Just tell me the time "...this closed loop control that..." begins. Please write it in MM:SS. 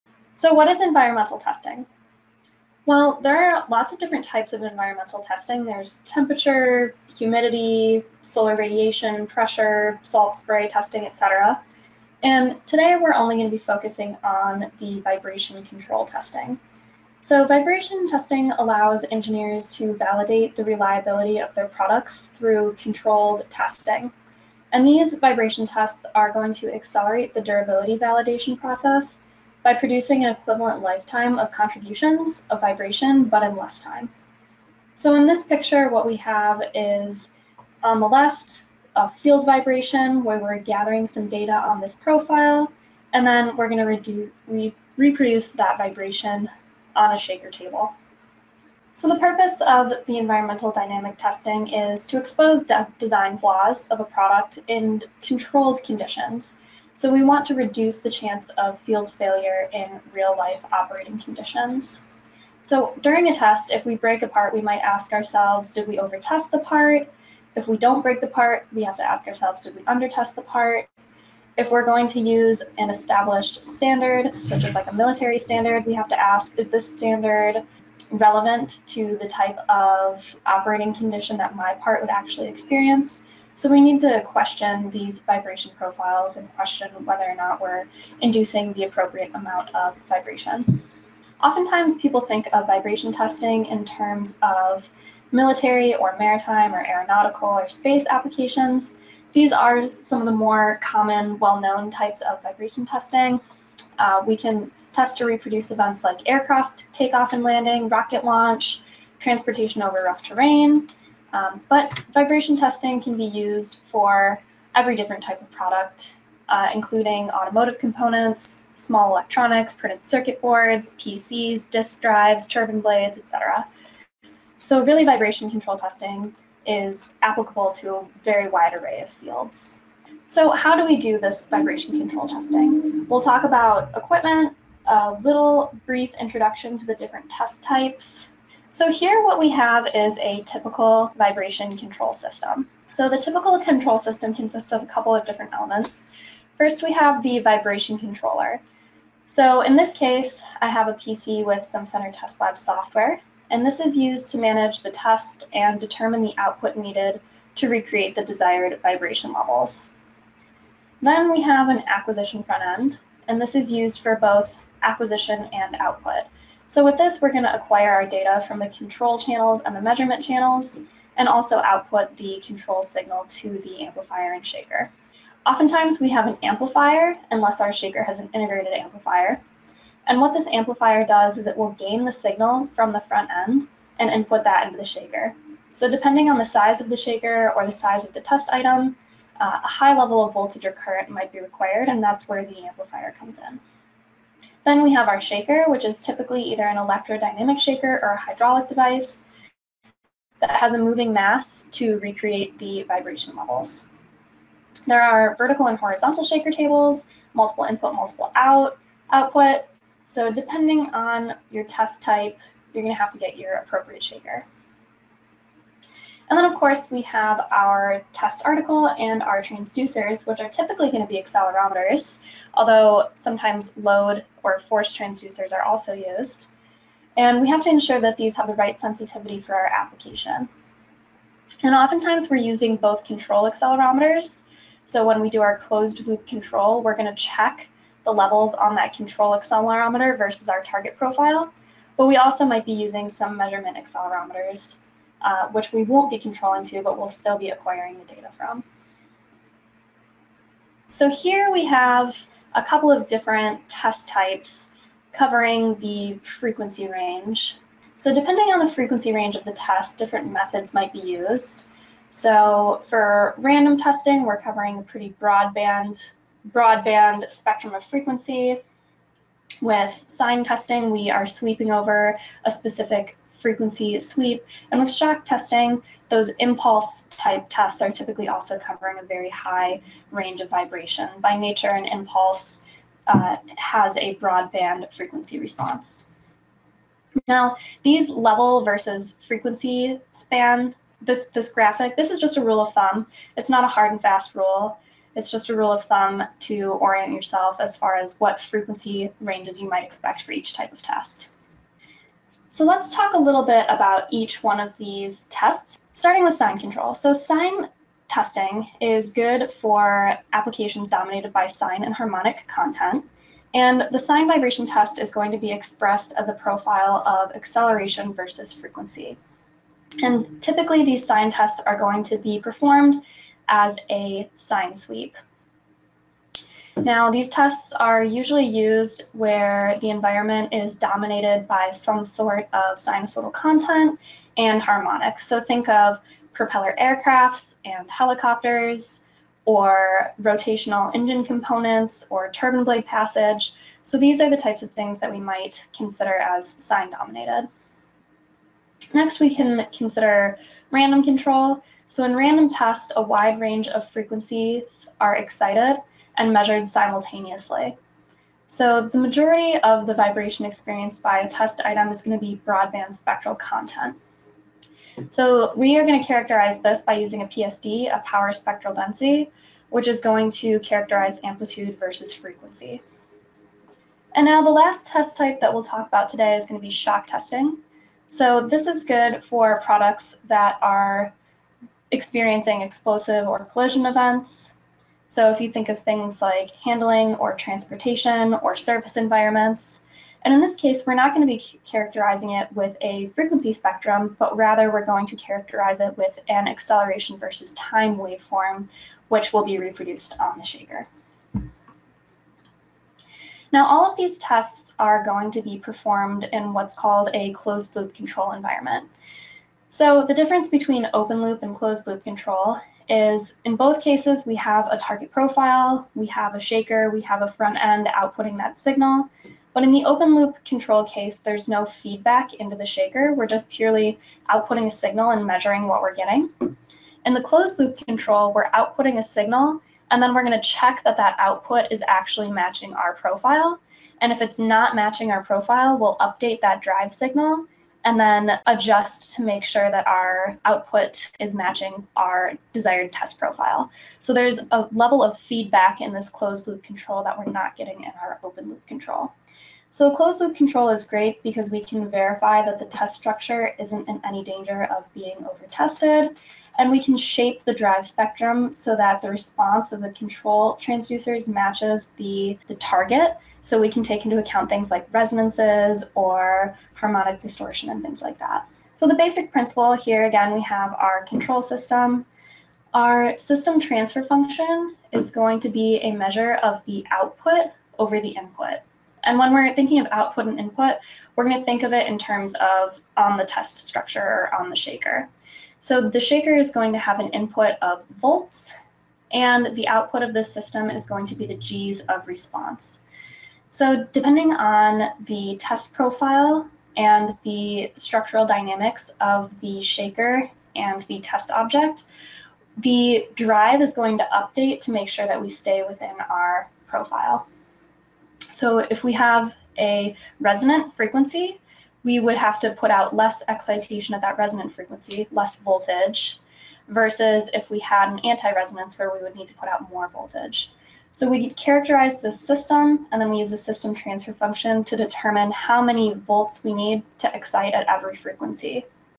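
07:25.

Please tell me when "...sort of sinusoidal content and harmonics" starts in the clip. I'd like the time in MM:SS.
05:32.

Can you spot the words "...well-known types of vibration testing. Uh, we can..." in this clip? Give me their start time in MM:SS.
01:41.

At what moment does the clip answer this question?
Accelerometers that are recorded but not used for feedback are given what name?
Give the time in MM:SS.
04:03.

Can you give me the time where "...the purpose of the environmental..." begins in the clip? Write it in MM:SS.
00:49.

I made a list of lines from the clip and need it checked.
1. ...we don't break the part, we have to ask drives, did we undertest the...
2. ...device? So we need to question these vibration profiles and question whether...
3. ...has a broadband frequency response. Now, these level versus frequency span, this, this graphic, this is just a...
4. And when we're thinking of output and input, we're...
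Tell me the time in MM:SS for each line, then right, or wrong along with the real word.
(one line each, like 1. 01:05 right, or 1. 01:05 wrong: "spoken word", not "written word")
1. 01:07 wrong: "ourselves", not "drives"
2. 01:22 wrong: "experience", not "device"
3. 04:43 right
4. 07:59 right.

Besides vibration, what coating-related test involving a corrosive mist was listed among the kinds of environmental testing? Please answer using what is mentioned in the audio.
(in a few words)
Salt spray testing.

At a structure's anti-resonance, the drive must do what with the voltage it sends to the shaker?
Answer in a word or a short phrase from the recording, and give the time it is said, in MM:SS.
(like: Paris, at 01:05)
Put out more voltage, at 08:39.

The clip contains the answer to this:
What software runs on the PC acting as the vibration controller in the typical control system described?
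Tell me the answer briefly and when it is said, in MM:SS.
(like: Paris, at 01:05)
Simcenter Testlab, at 02:31.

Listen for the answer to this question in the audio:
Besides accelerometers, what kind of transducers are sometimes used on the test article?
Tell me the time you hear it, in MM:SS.
03:43.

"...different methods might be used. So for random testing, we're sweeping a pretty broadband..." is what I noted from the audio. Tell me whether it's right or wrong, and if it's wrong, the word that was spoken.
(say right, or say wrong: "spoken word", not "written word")
wrong: "covering", not "sweeping".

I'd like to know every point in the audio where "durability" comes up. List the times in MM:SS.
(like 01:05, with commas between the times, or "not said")
00:27.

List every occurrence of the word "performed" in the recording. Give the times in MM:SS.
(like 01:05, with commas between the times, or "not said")
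05:22, 06:45.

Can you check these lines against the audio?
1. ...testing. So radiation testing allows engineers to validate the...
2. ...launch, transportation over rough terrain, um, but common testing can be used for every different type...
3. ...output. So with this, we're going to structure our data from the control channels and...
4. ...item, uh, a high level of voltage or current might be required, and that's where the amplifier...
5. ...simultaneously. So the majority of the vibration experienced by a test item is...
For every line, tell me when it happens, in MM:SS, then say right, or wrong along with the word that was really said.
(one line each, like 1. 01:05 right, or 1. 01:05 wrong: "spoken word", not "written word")
1. 00:16 wrong: "vibration", not "radiation"
2. 01:48 wrong: "vibration", not "common"
3. 02:45 wrong: "acquire", not "structure"
4. 03:08 right
5. 05:56 right.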